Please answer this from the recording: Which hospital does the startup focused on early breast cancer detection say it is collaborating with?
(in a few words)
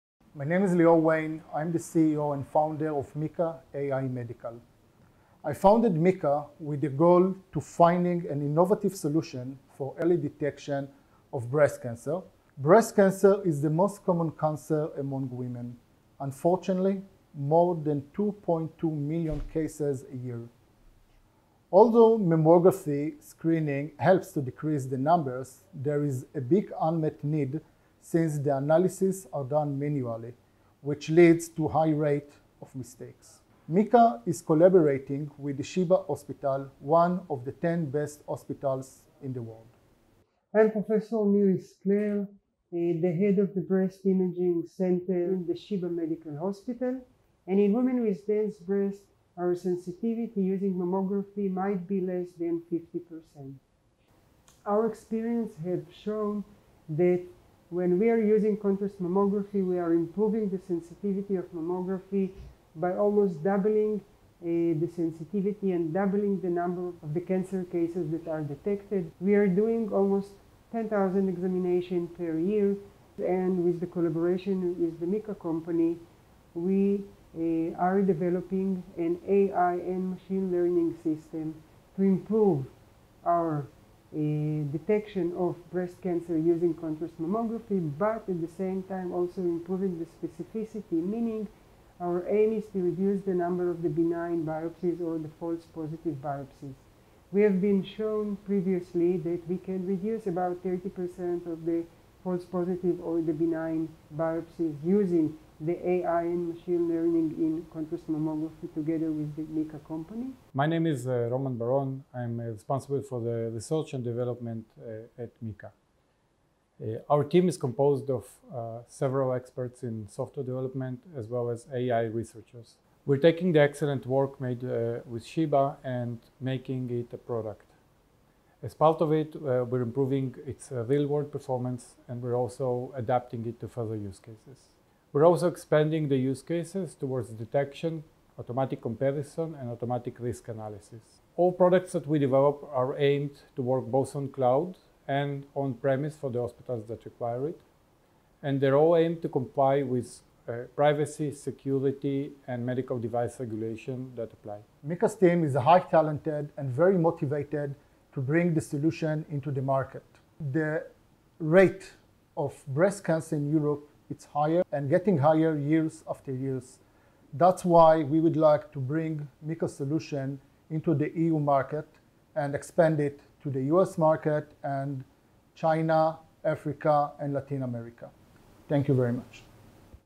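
Sheba Hospital.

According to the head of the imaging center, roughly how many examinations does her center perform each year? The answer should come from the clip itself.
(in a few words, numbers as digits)
10,000.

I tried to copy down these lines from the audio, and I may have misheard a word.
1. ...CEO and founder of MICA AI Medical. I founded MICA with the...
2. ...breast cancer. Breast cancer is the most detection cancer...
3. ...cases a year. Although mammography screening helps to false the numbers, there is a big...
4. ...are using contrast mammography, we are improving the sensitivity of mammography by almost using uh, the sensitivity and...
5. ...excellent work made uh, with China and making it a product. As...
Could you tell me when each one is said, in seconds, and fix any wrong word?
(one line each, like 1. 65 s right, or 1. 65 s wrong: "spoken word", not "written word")
1. 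1 s right
2. 11 s wrong: "common", not "detection"
3. 19 s wrong: "decrease", not "false"
4. 58 s wrong: "doubling", not "using"
5. 123 s wrong: "Sheba", not "China".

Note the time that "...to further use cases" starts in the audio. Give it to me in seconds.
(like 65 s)
133 s.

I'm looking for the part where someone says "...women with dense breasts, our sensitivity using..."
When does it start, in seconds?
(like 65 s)
47 s.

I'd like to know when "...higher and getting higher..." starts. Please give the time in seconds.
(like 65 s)
164 s.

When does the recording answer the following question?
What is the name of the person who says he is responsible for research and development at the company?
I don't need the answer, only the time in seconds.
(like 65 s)
111 s.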